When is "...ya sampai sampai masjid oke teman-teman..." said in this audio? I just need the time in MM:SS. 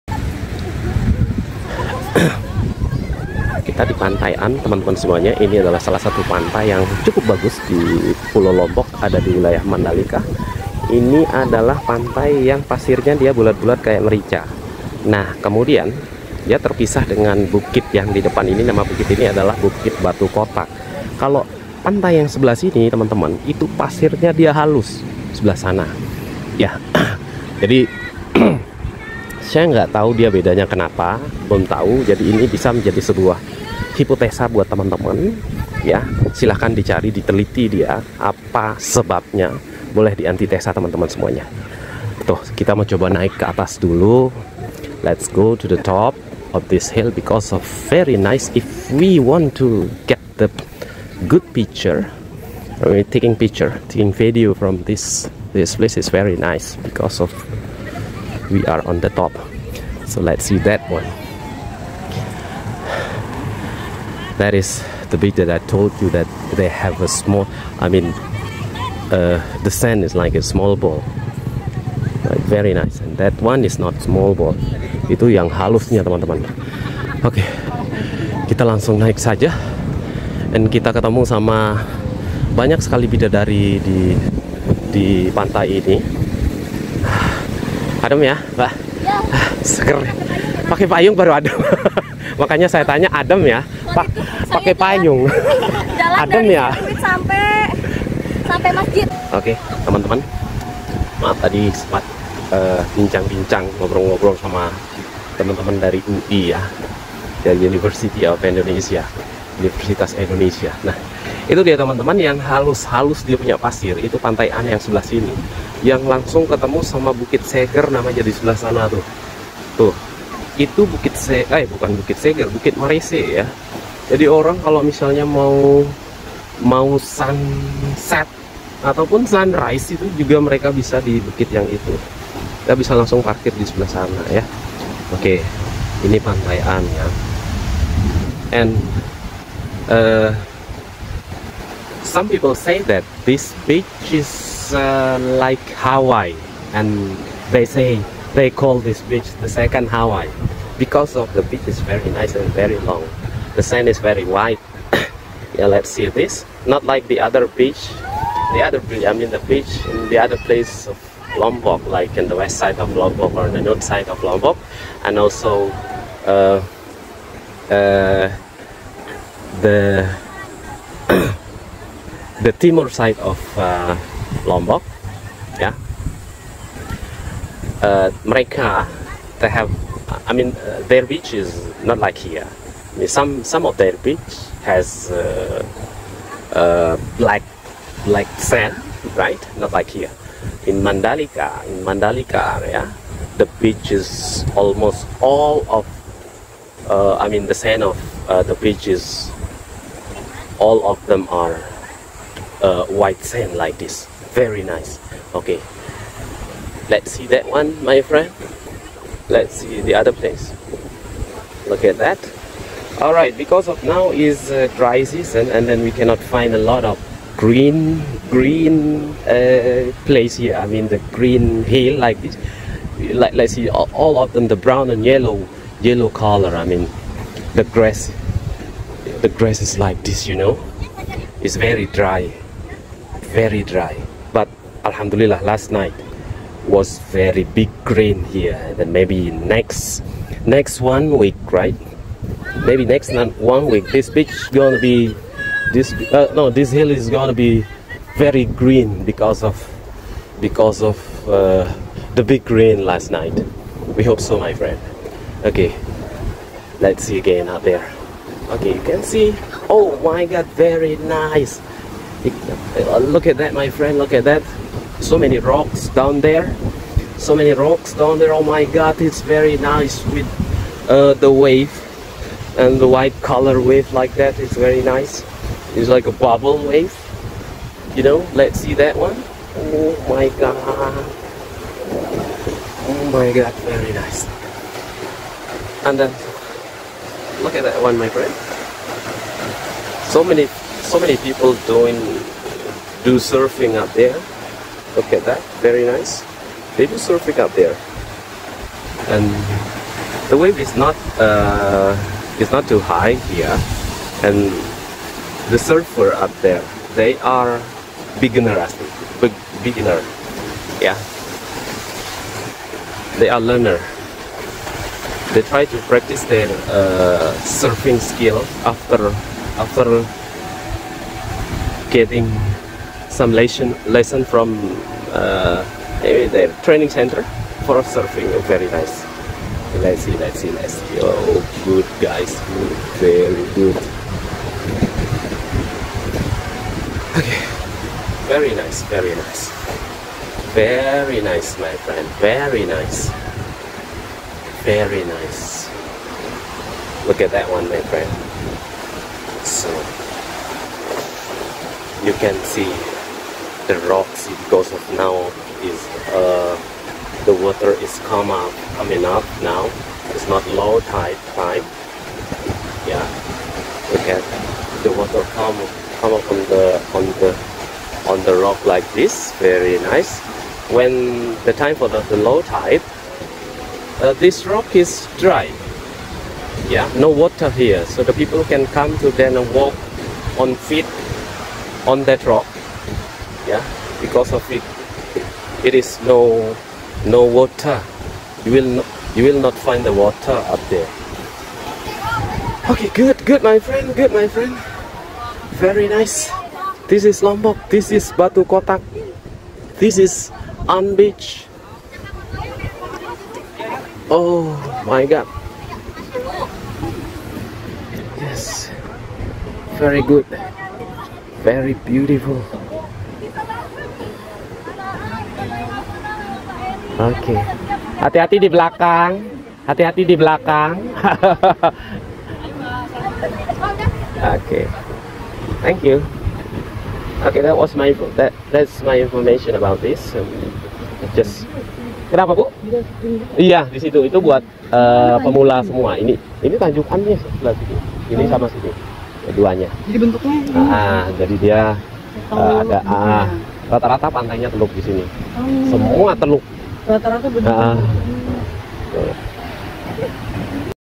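01:36.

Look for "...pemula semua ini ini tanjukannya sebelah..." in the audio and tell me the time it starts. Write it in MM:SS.
07:15.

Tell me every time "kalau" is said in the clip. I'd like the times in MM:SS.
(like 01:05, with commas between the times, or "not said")
00:21, 02:04.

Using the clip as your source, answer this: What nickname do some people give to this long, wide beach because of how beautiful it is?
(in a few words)
the second Hawaii.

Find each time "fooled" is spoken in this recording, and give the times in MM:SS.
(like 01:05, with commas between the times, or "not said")
not said.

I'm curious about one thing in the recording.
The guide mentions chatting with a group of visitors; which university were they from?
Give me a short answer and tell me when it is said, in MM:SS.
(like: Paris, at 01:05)
Universitas Indonesia, at 01:49.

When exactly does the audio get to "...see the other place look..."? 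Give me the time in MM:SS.
03:29.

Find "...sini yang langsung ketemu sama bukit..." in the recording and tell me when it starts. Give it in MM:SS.
01:55.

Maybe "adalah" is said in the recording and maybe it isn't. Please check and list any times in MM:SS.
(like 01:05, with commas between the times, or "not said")
00:05, 00:11, 00:19.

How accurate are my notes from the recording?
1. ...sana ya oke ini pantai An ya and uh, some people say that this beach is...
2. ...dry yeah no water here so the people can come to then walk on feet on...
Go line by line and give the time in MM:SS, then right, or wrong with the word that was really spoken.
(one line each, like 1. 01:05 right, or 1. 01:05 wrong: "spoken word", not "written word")
1. 02:13 right
2. 06:15 right.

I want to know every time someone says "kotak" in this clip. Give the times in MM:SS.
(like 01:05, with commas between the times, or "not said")
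00:20, 06:38.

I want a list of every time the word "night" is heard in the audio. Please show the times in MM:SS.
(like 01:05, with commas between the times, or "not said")
03:55, 04:13.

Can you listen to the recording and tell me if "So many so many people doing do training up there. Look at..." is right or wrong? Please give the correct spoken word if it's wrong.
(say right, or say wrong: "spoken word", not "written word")
wrong: "surfing", not "training".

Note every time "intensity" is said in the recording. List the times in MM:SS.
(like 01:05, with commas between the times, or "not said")
not said.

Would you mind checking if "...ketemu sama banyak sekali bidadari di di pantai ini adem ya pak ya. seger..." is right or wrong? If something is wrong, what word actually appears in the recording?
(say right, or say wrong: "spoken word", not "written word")
right.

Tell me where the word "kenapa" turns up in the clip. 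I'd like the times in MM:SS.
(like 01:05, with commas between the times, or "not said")
00:30, 07:12.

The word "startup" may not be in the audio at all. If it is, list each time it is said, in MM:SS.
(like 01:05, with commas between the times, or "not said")
not said.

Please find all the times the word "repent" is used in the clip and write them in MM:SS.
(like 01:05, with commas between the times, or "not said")
not said.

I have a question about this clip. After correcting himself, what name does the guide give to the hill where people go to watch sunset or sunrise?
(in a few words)
Bukit Marese.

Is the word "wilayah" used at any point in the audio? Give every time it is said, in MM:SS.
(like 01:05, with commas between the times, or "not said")
00:09.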